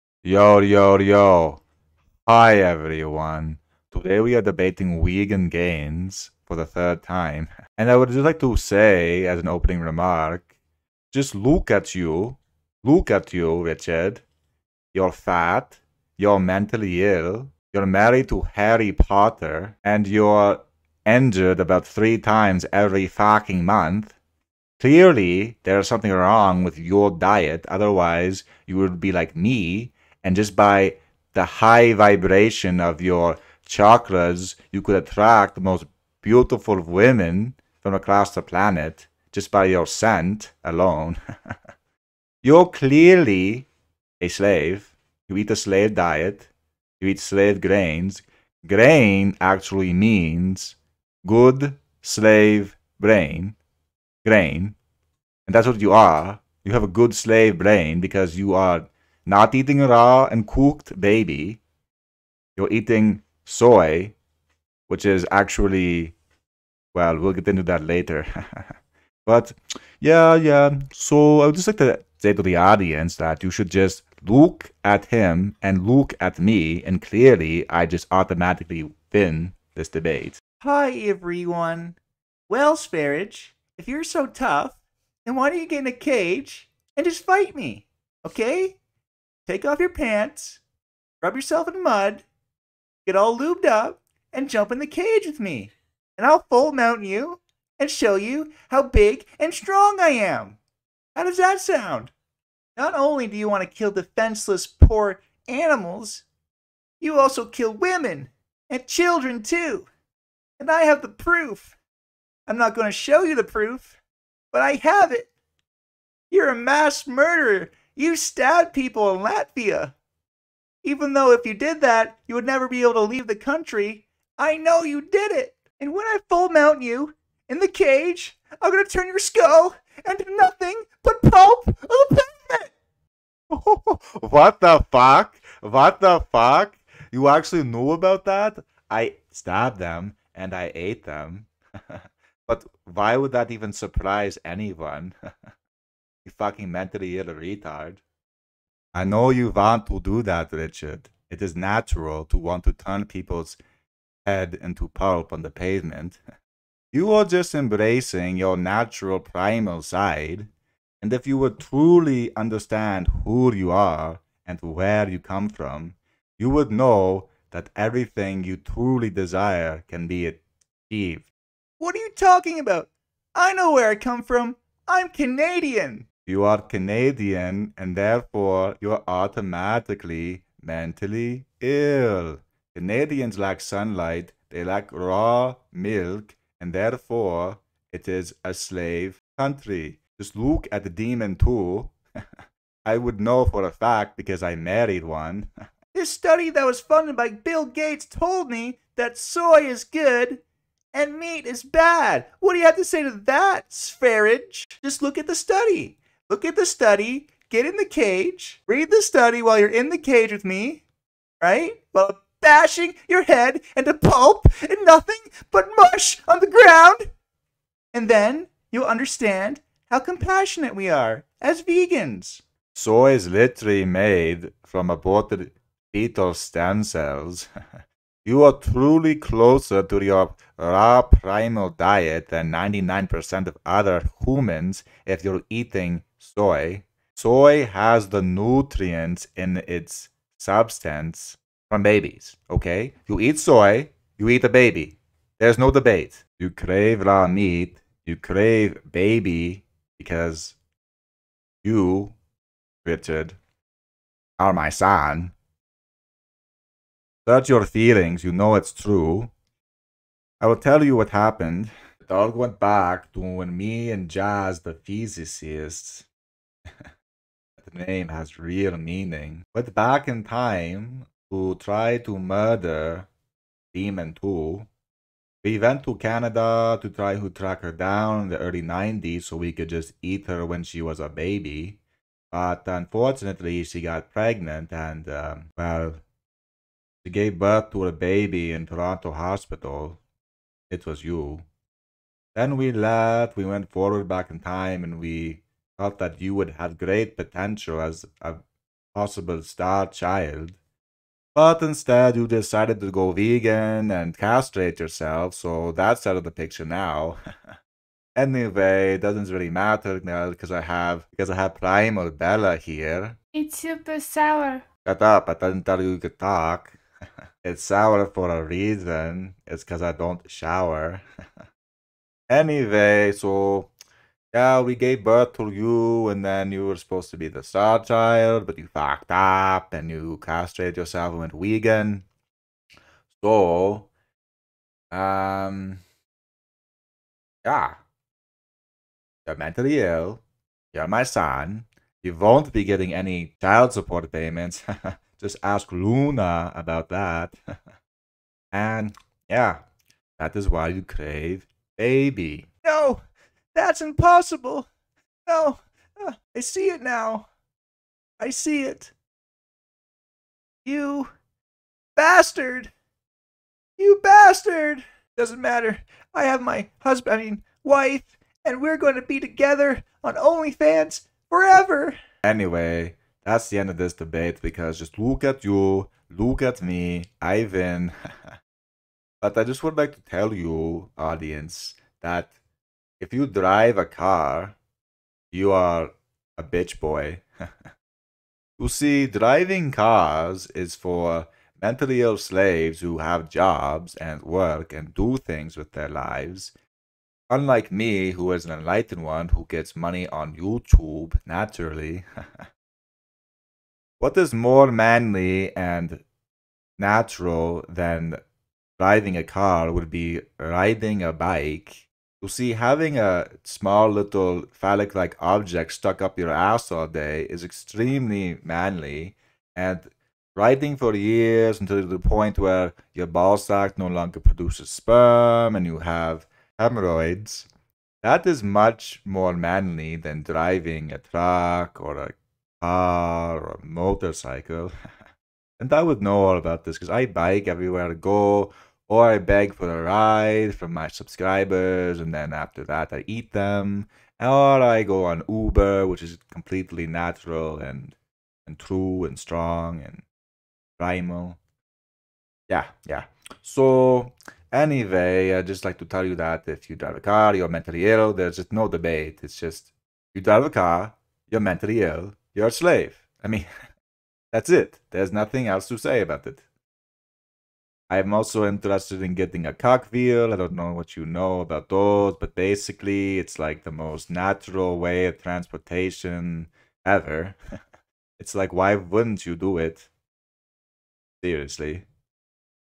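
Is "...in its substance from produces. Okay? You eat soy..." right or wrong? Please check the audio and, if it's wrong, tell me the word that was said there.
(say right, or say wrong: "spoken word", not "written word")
wrong: "babies", not "produces".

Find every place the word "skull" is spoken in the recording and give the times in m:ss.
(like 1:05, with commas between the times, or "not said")
2:09.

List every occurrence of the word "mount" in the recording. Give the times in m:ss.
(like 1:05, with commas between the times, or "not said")
1:36, 2:06.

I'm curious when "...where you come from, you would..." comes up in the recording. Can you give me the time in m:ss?
2:44.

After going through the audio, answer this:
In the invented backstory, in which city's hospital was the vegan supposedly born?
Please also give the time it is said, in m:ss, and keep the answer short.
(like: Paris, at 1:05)
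Toronto, at 4:48.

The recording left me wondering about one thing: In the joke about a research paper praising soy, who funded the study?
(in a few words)
Bill Gates.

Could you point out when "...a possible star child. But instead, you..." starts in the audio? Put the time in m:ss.
4:58.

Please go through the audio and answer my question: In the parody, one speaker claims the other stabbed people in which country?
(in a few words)
Latvia.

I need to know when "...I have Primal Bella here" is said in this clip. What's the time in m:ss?
5:11.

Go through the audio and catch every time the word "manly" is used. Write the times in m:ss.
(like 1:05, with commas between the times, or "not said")
6:44, 6:58, 7:09.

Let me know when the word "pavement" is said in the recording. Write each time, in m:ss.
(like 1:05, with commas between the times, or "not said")
2:12, 2:35.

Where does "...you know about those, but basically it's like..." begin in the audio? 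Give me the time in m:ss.
7:50.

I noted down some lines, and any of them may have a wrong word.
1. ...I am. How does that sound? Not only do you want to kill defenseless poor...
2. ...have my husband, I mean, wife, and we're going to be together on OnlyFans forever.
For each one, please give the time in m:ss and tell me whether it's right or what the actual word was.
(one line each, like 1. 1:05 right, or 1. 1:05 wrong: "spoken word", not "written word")
1. 1:39 right
2. 6:06 right.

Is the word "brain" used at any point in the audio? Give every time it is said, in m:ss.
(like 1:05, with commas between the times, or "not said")
0:52, 0:57.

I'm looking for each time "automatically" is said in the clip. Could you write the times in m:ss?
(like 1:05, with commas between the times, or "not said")
1:18, 2:59.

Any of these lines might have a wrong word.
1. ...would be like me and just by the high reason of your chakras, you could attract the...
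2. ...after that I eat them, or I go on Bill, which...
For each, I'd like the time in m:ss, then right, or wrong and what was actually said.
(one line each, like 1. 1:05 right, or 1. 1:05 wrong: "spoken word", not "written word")
1. 0:28 wrong: "vibration", not "reason"
2. 7:22 wrong: "Uber", not "Bill".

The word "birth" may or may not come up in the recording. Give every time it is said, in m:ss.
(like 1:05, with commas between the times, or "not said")
4:47, 5:25.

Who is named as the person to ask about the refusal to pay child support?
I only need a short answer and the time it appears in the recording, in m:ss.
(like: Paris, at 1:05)
Luna, at 5:45.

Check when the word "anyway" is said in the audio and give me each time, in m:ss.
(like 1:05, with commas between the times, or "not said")
5:08, 5:22, 6:12, 7:34.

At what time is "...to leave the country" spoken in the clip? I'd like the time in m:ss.
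2:02.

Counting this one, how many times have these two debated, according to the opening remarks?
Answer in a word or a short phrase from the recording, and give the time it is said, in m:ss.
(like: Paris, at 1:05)
3, at 0:06.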